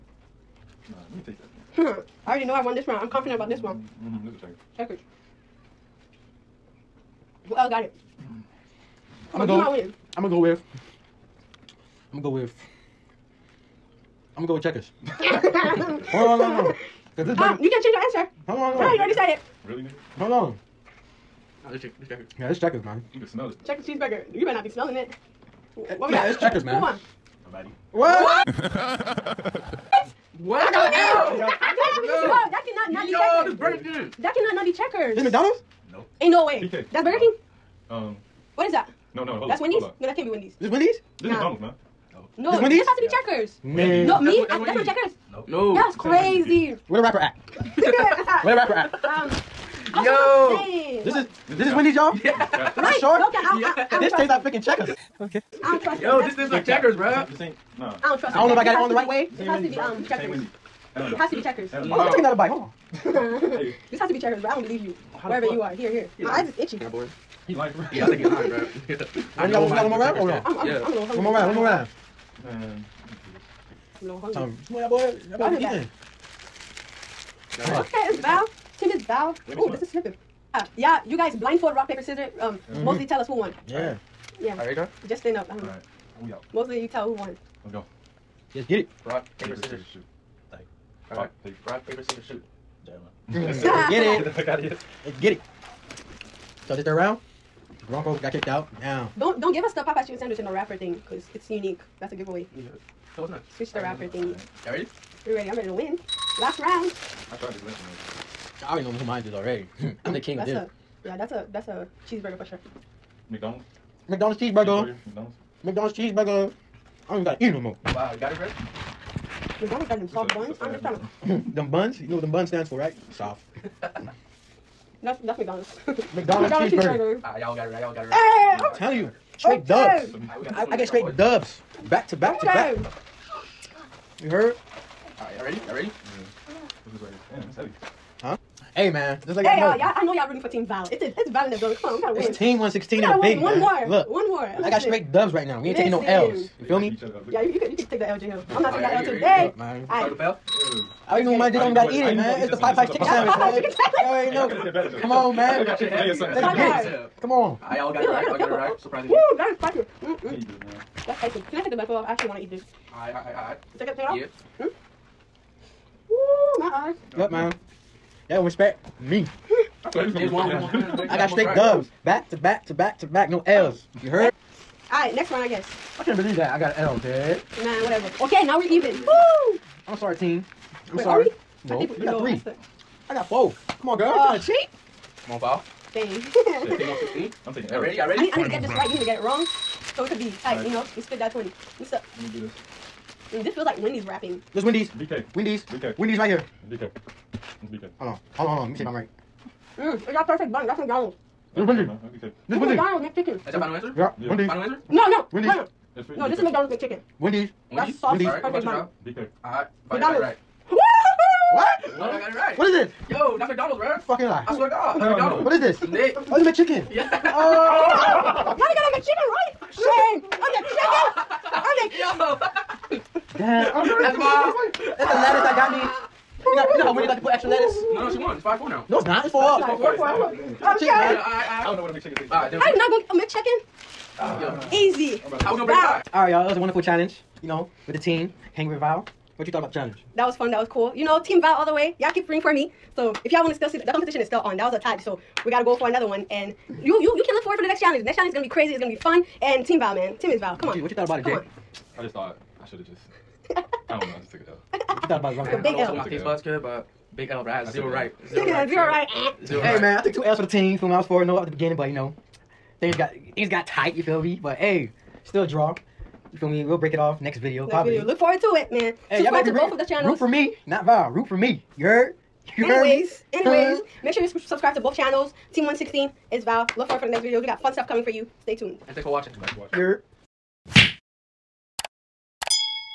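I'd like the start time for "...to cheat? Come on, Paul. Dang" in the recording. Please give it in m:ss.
3:04.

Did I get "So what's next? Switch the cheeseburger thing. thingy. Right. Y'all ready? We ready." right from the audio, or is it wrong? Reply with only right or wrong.
wrong.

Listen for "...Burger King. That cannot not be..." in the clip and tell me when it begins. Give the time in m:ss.
0:33.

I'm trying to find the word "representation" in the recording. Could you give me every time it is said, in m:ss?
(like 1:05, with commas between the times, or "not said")
not said.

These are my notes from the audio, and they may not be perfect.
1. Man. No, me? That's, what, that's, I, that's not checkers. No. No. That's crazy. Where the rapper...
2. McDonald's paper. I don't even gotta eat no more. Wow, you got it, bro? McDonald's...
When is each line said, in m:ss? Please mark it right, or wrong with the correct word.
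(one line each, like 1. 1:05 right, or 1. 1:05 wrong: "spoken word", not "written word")
1. 0:43 right
2. 1:55 wrong: "cheeseburger", not "paper".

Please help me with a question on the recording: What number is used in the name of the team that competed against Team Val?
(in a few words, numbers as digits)
116.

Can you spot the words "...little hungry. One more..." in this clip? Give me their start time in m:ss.
1:10.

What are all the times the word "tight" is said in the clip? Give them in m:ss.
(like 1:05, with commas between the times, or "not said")
3:10, 4:23.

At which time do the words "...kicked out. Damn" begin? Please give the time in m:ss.
1:38.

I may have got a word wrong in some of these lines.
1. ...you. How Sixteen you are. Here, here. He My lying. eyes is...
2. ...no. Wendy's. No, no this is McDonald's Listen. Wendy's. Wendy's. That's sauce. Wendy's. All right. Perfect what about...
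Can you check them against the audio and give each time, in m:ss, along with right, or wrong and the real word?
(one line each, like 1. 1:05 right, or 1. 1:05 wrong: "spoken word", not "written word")
1. 1:04 wrong: "Wherever", not "Sixteen"
2. 3:25 wrong: "McChicken", not "Listen".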